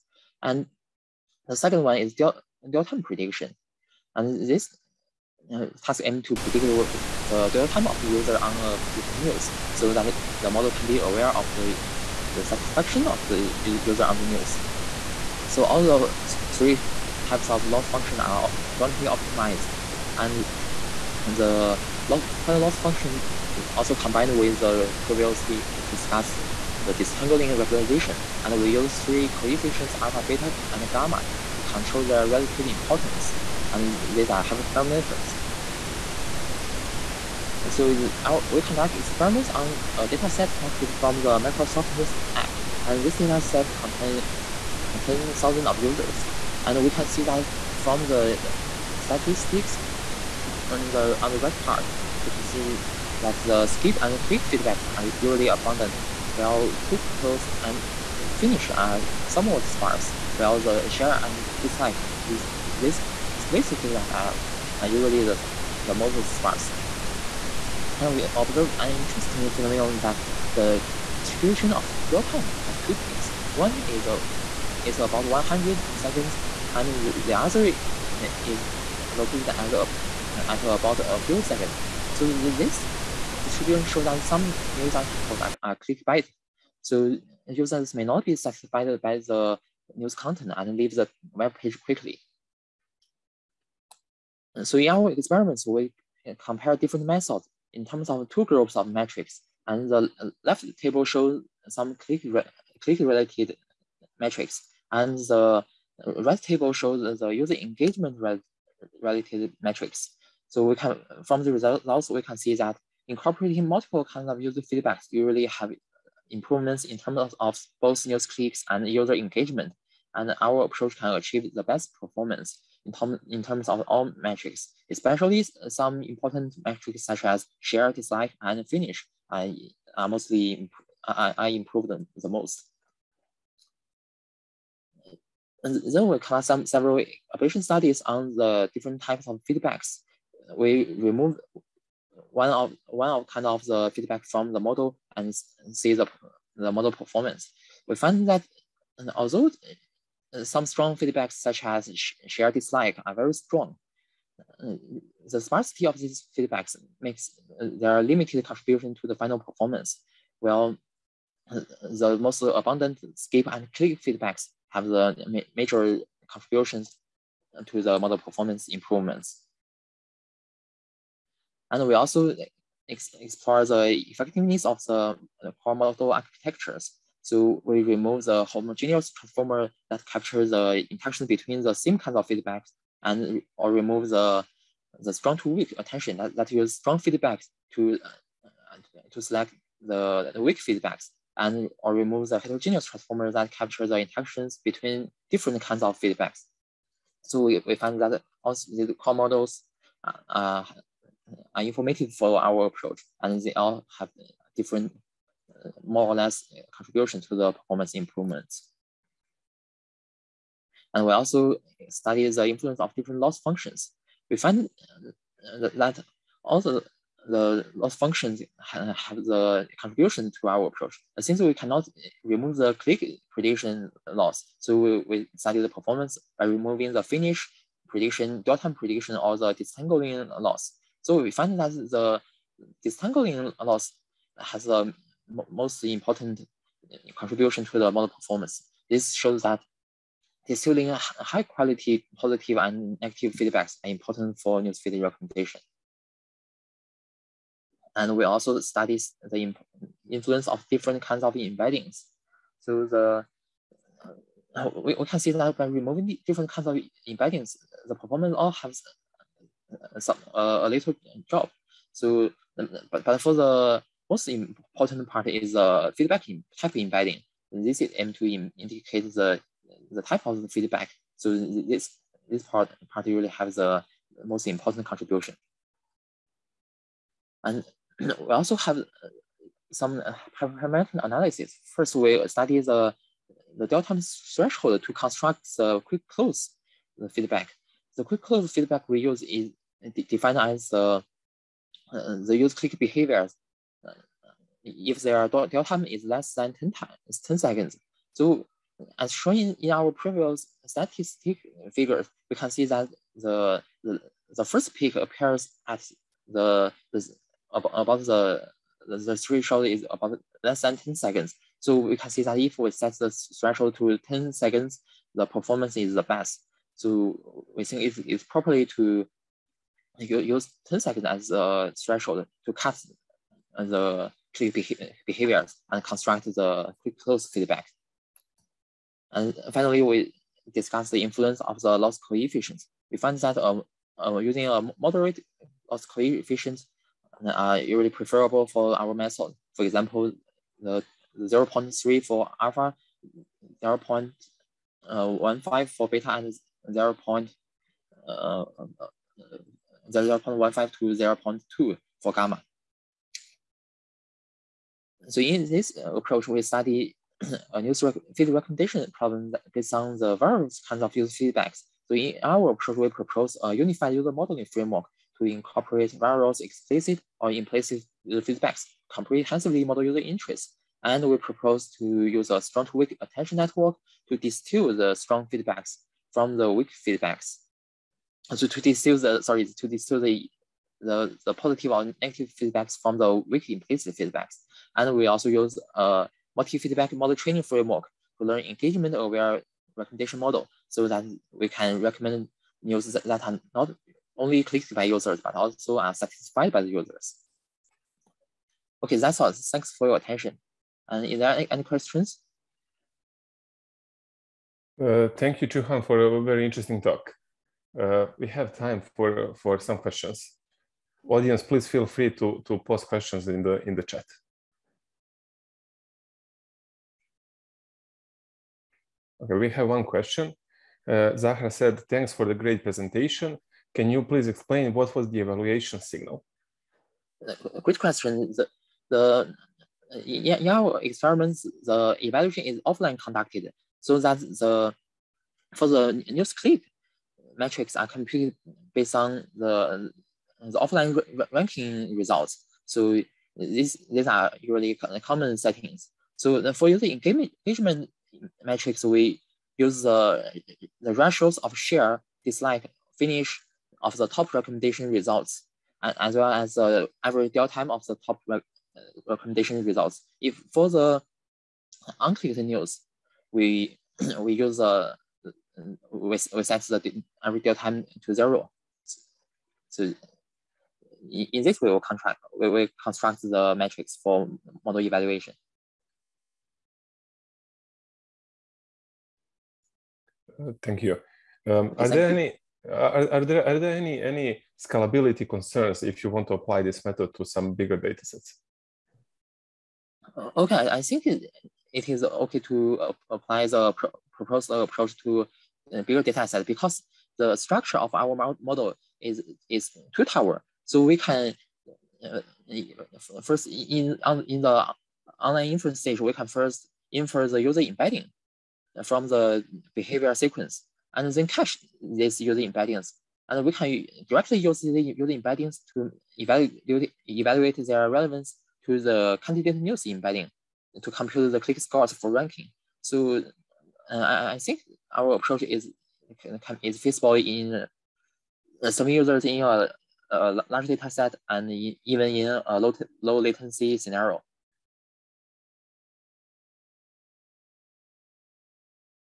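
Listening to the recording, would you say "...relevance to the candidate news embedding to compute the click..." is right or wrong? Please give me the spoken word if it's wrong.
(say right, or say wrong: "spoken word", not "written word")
right.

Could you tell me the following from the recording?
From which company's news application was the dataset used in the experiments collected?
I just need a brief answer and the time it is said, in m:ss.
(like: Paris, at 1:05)
Microsoft, at 0:41.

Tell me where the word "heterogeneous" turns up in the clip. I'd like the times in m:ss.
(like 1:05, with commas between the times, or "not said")
3:12.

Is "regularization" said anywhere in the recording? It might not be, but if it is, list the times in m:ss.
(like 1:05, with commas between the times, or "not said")
0:27.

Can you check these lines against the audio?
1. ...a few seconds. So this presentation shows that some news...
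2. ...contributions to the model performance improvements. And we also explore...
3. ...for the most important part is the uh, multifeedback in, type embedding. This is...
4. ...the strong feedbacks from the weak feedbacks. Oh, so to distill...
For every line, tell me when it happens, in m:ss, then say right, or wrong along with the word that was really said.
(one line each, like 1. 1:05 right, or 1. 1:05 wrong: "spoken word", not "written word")
1. 1:21 wrong: "distribution", not "presentation"
2. 2:46 right
3. 4:23 wrong: "feedback", not "multifeedback"
4. 6:14 right.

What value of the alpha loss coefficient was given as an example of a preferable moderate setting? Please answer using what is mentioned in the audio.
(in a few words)
0.3.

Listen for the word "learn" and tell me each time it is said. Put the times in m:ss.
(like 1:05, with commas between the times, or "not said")
6:28.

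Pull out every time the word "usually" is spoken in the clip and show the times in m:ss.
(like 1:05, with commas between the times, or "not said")
0:55, 1:04, 1:55, 5:37, 7:24.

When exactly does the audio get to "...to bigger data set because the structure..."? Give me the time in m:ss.
8:15.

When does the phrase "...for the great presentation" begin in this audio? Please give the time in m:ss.
7:02.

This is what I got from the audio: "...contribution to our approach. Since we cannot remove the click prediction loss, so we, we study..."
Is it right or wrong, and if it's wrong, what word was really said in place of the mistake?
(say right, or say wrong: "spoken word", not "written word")
right.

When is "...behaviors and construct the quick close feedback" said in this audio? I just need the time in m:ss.
5:25.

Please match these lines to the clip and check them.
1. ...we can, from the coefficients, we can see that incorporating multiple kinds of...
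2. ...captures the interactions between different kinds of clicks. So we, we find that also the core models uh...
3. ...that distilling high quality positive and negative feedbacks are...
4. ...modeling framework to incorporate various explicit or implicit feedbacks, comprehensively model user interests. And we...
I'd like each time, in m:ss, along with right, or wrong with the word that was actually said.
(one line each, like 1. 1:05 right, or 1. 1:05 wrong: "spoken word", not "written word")
1. 1:50 wrong: "results", not "coefficients"
2. 3:13 wrong: "feedbacks", not "clicks"
3. 3:59 right
4. 6:04 right.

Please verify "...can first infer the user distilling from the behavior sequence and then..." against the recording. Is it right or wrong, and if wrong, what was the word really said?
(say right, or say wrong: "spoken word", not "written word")
wrong: "embedding", not "distilling".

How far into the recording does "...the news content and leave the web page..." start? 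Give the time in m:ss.
1:29.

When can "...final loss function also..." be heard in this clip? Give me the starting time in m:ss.
0:22.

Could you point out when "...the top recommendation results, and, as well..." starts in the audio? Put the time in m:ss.
7:33.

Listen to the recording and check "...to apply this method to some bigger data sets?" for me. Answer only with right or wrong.
right.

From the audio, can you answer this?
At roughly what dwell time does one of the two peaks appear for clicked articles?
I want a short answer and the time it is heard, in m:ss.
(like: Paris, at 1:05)
about 100 seconds, at 1:14.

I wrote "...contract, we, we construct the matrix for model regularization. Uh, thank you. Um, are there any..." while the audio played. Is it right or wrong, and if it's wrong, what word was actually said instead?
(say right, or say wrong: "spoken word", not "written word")
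wrong: "evaluation", not "regularization".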